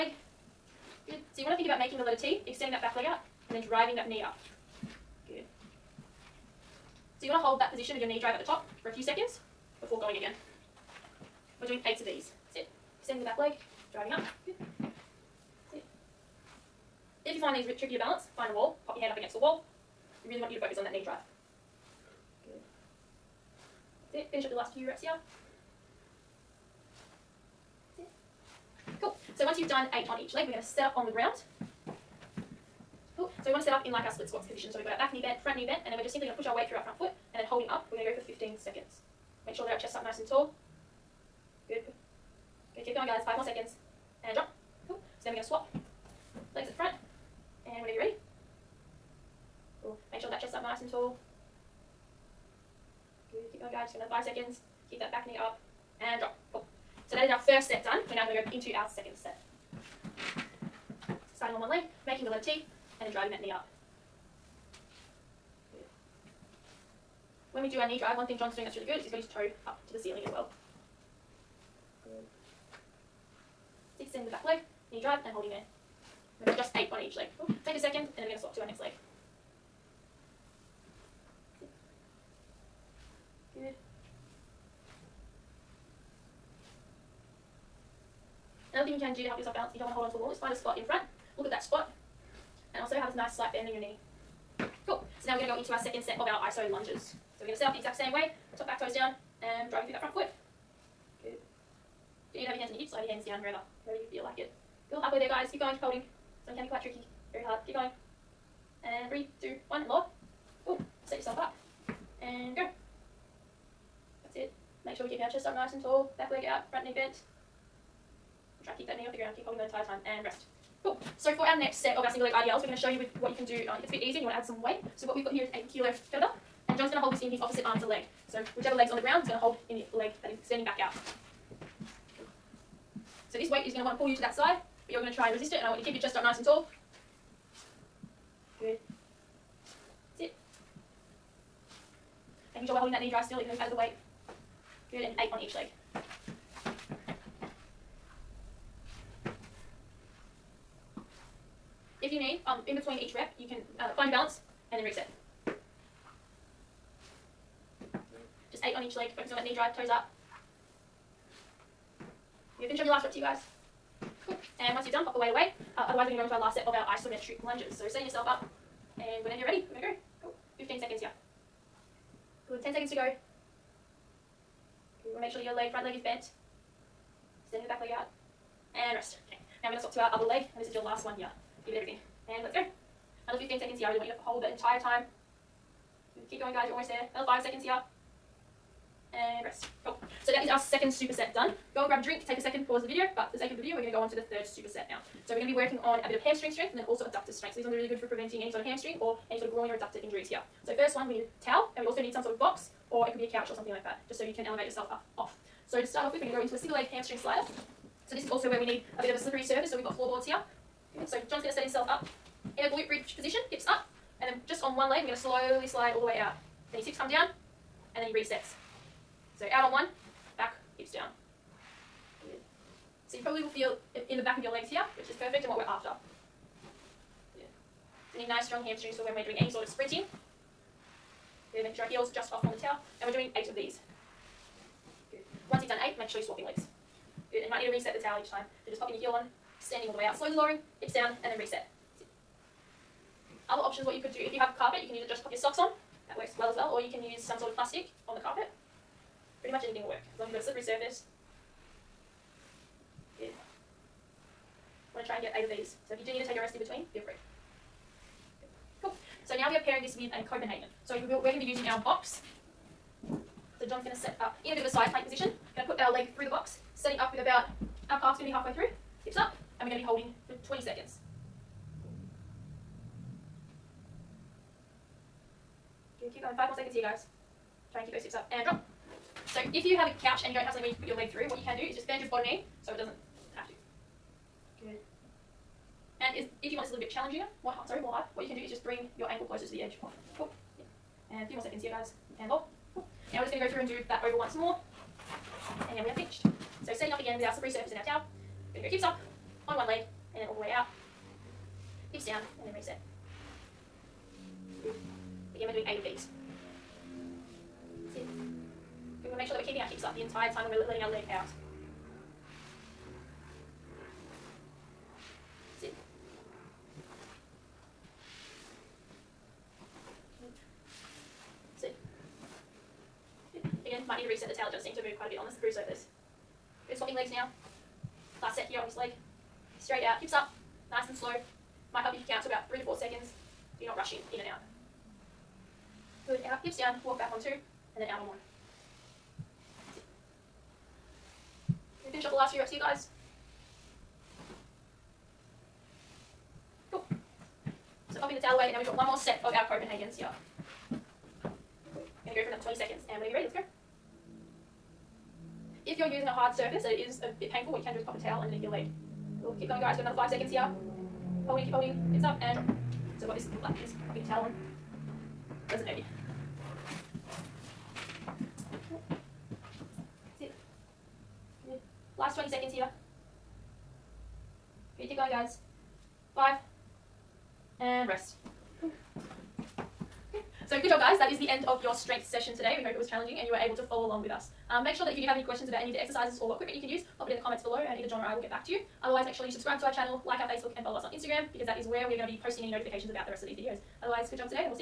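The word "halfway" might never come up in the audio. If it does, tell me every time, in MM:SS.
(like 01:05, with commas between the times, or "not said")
01:45, 04:28.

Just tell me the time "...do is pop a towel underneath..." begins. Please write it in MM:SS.
05:57.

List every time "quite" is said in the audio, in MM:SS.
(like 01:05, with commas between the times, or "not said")
01:46, 05:24.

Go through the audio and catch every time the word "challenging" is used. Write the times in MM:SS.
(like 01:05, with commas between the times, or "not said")
04:46, 06:22.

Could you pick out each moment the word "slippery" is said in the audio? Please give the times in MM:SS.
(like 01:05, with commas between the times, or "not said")
03:29, 04:10, 04:57.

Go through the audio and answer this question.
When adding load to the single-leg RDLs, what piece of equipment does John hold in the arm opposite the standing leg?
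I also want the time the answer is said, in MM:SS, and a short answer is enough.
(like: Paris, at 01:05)
kettlebell, at 02:06.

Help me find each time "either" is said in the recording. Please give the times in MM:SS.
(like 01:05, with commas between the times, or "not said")
01:42, 06:27.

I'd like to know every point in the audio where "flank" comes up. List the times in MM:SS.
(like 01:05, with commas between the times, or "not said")
not said.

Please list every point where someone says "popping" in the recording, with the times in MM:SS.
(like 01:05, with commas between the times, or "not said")
03:58, 05:48, 06:03.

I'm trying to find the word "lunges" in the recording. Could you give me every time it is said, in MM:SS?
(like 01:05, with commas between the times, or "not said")
01:36, 02:47.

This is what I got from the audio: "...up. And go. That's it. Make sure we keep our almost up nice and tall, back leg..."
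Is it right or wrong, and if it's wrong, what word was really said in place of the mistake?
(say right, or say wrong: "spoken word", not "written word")
wrong: "chest", not "almost".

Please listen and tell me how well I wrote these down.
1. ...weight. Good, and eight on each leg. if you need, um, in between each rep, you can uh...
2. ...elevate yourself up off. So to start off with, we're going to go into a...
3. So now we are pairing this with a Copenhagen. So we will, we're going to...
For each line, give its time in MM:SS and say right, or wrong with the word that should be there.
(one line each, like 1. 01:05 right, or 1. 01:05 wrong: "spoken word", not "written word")
1. 02:23 right
2. 03:24 right
3. 04:19 right.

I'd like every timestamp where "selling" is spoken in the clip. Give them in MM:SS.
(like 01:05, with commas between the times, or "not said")
not said.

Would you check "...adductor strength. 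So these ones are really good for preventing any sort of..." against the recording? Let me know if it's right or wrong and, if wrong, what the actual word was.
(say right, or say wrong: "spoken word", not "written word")
right.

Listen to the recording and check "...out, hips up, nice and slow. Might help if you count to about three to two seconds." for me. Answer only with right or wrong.
wrong.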